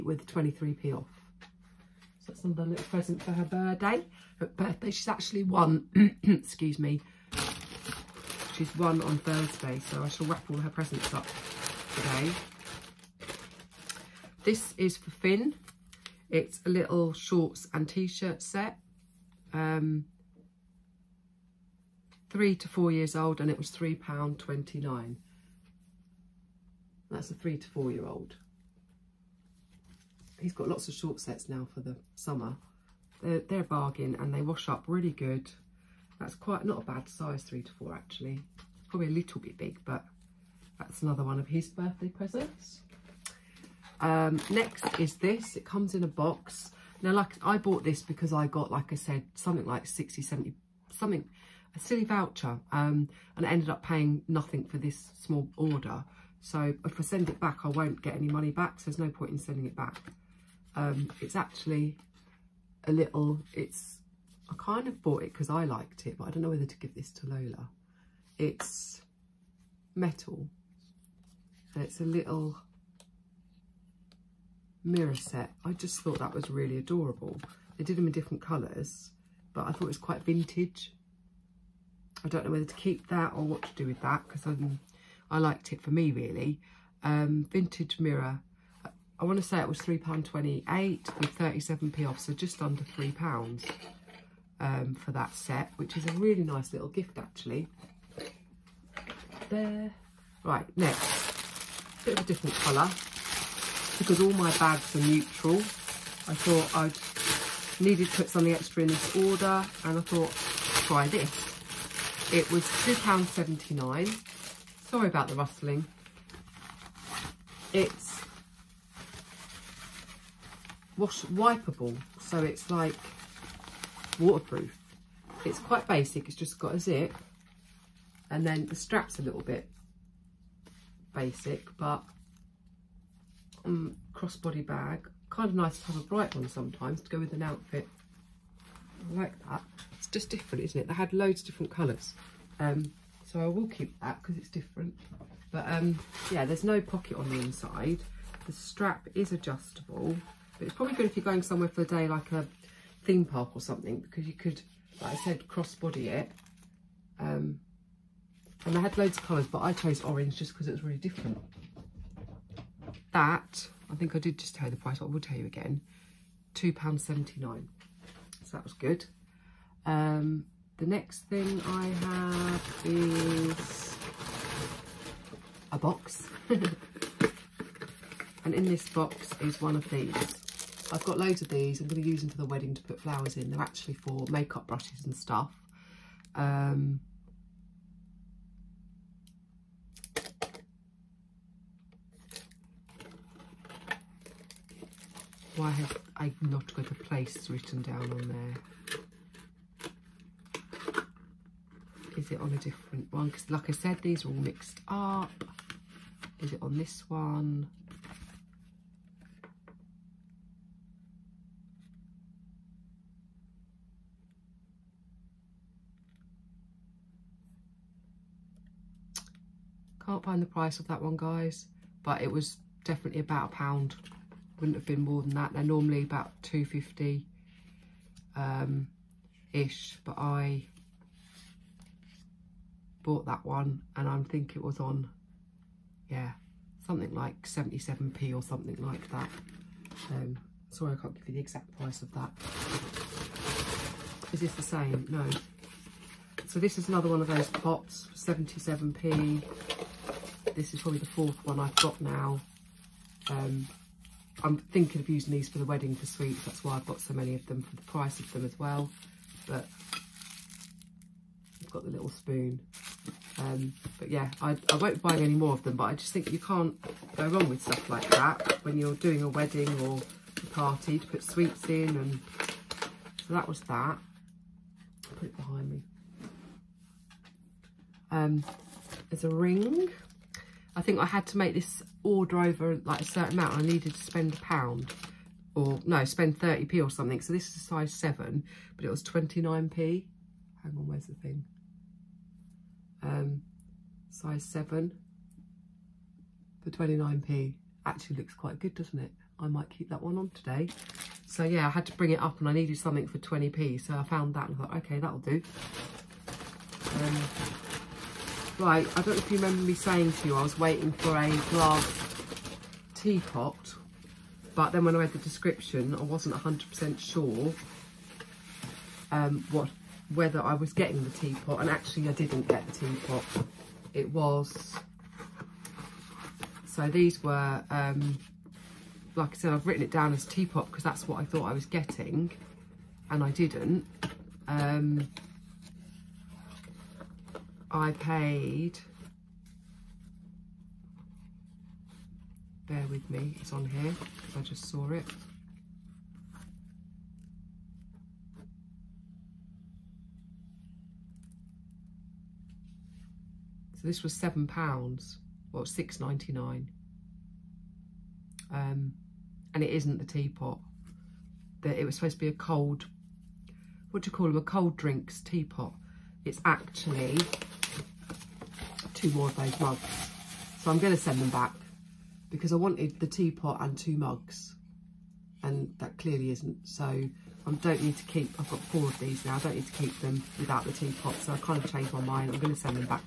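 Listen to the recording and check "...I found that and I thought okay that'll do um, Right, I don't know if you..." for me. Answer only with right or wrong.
right.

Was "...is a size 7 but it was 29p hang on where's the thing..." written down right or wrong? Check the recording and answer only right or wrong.
right.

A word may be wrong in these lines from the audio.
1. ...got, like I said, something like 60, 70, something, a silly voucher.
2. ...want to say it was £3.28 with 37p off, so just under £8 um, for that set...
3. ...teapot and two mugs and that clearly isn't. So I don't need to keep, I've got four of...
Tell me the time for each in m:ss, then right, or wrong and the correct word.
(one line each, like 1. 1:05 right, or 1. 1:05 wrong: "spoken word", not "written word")
1. 0:48 right
2. 1:29 wrong: "3", not "8"
3. 6:13 right.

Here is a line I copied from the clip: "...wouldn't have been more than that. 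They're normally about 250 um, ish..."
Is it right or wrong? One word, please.
right.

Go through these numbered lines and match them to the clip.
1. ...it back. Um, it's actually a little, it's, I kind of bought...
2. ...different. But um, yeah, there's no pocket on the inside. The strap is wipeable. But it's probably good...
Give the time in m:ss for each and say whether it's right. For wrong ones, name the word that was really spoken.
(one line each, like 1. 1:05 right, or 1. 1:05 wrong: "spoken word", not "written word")
1. 0:59 right
2. 2:24 wrong: "adjustable", not "wipeable".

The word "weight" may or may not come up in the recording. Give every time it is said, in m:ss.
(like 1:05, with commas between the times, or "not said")
not said.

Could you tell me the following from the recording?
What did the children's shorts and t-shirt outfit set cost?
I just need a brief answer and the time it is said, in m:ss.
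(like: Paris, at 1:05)
£3.29, at 0:23.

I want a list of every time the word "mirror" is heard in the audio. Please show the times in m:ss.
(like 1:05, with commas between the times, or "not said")
1:14, 1:27.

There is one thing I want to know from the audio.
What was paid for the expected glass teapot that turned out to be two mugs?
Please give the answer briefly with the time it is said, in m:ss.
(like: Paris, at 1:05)
£6.99, at 5:55.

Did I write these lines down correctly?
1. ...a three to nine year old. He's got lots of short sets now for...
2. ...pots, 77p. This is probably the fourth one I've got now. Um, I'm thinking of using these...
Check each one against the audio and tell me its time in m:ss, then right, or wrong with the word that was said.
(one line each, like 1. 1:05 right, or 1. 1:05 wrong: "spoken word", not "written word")
1. 0:27 wrong: "four", not "nine"
2. 4:07 right.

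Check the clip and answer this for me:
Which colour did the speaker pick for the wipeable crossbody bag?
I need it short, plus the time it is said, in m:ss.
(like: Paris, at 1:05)
orange, at 2:40.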